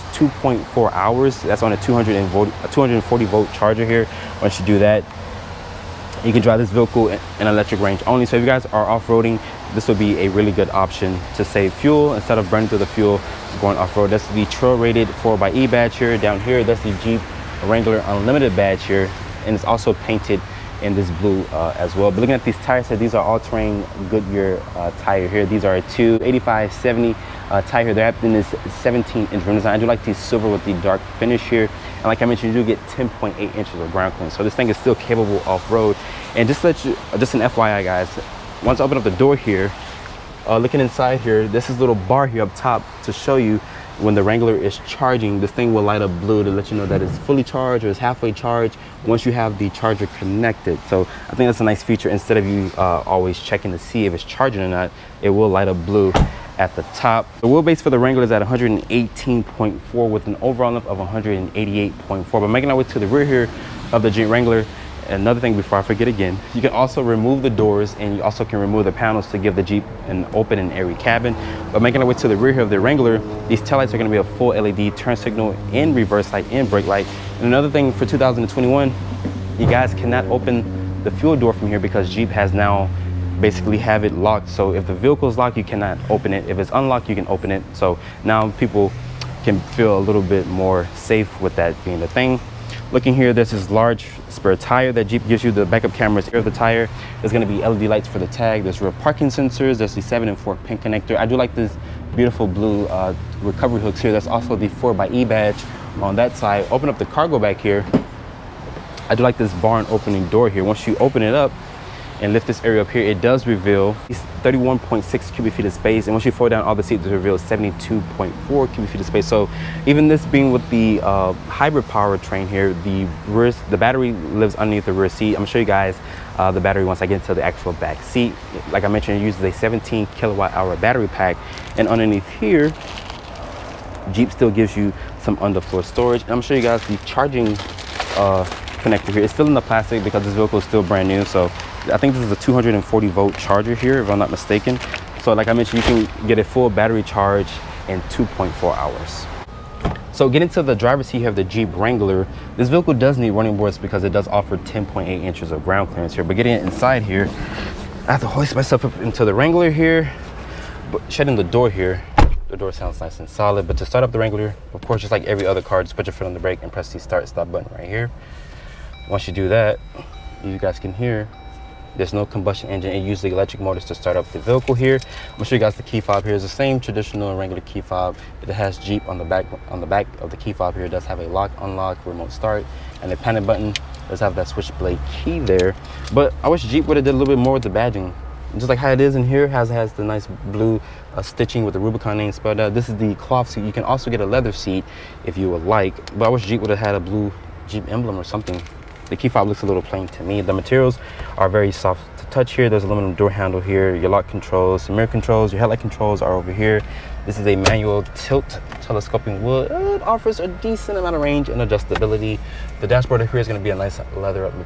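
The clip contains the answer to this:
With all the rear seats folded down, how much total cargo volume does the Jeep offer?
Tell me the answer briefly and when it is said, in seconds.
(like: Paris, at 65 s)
72.4 cubic feet, at 117 s.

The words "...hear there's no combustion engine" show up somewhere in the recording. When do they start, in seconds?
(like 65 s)
170 s.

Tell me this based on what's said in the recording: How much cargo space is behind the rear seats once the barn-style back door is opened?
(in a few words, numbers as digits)
31.6 cubic feet.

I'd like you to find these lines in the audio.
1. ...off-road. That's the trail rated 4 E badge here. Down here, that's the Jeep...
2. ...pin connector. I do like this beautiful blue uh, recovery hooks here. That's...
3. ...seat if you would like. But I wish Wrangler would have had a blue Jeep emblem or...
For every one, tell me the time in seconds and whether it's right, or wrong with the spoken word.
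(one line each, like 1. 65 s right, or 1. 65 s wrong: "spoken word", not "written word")
1. 13 s right
2. 100 s right
3. 194 s wrong: "Jeep", not "Wrangler".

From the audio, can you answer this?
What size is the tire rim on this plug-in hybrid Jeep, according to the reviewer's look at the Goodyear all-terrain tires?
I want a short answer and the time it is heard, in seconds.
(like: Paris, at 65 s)
17-inch, at 28 s.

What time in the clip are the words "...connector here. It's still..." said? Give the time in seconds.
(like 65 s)
138 s.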